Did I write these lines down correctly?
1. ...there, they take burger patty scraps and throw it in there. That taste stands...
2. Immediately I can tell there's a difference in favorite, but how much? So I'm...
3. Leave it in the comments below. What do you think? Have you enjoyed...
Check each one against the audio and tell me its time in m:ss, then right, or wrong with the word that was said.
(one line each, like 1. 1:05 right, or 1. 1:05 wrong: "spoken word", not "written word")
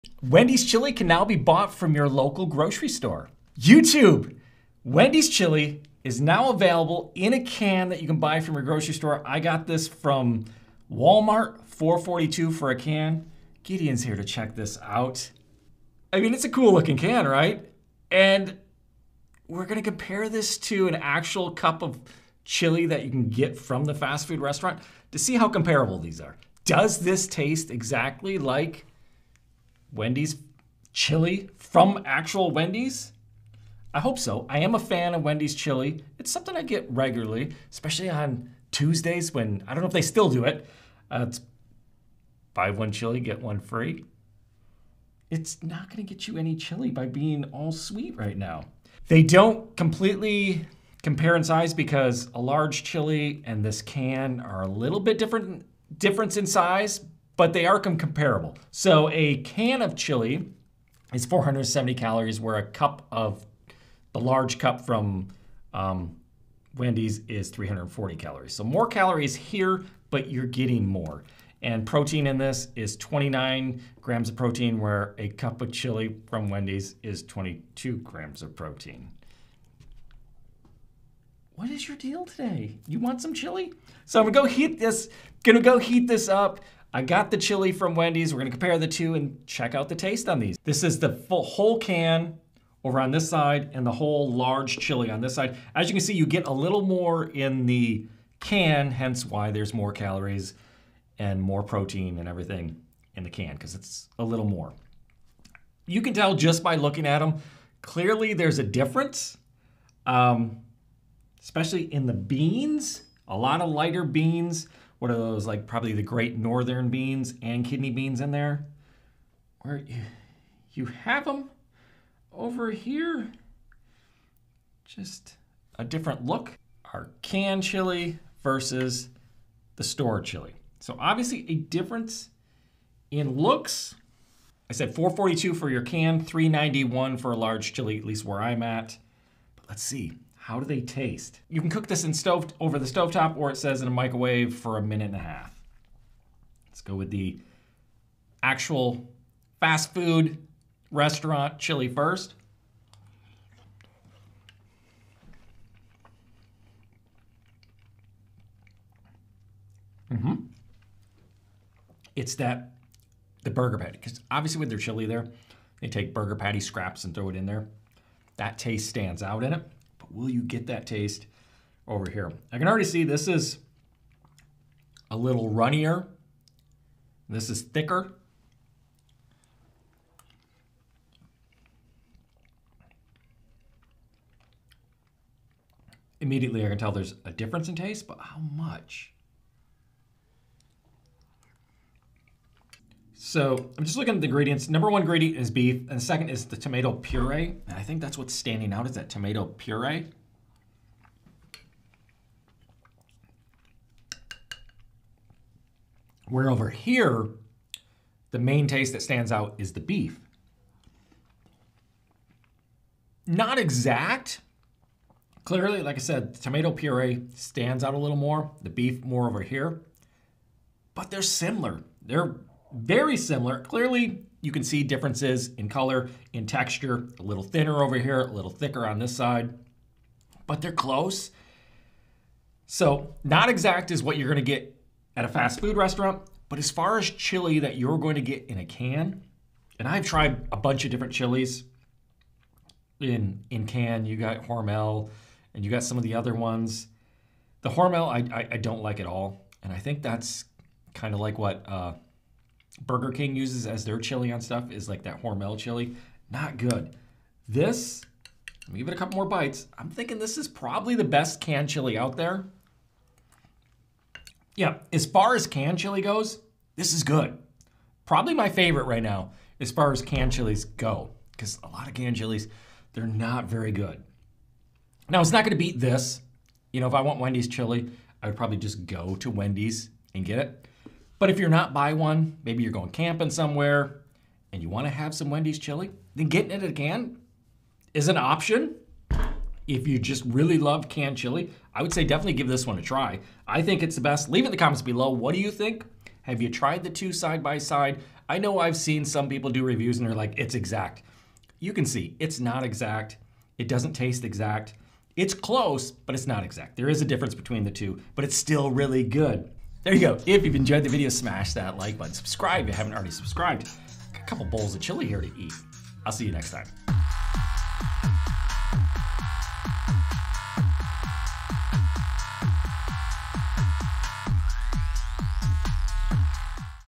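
1. 2:45 right
2. 3:06 wrong: "taste", not "favorite"
3. 4:54 wrong: "tried", not "enjoyed".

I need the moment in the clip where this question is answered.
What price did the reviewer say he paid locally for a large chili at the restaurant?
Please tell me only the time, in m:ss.
2:16.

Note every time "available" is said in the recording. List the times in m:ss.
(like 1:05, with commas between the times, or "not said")
0:06.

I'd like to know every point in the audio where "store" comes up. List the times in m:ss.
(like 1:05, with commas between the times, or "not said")
0:02, 0:08, 2:09.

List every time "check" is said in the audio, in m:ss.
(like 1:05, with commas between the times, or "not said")
0:14, 1:29.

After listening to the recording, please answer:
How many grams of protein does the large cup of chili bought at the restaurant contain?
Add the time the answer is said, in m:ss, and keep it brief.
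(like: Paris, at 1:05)
22 grams, at 1:17.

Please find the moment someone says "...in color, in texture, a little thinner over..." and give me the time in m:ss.
3:45.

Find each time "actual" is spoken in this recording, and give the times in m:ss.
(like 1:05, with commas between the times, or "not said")
0:20, 0:32, 2:28.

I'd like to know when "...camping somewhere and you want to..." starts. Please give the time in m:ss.
4:42.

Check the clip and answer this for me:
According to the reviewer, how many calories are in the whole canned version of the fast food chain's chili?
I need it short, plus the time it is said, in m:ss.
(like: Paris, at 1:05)
470, at 1:01.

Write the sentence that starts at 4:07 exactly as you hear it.
The Hormel, I, I, I don't like at all.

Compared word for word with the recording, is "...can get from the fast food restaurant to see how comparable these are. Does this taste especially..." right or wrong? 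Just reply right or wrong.
wrong.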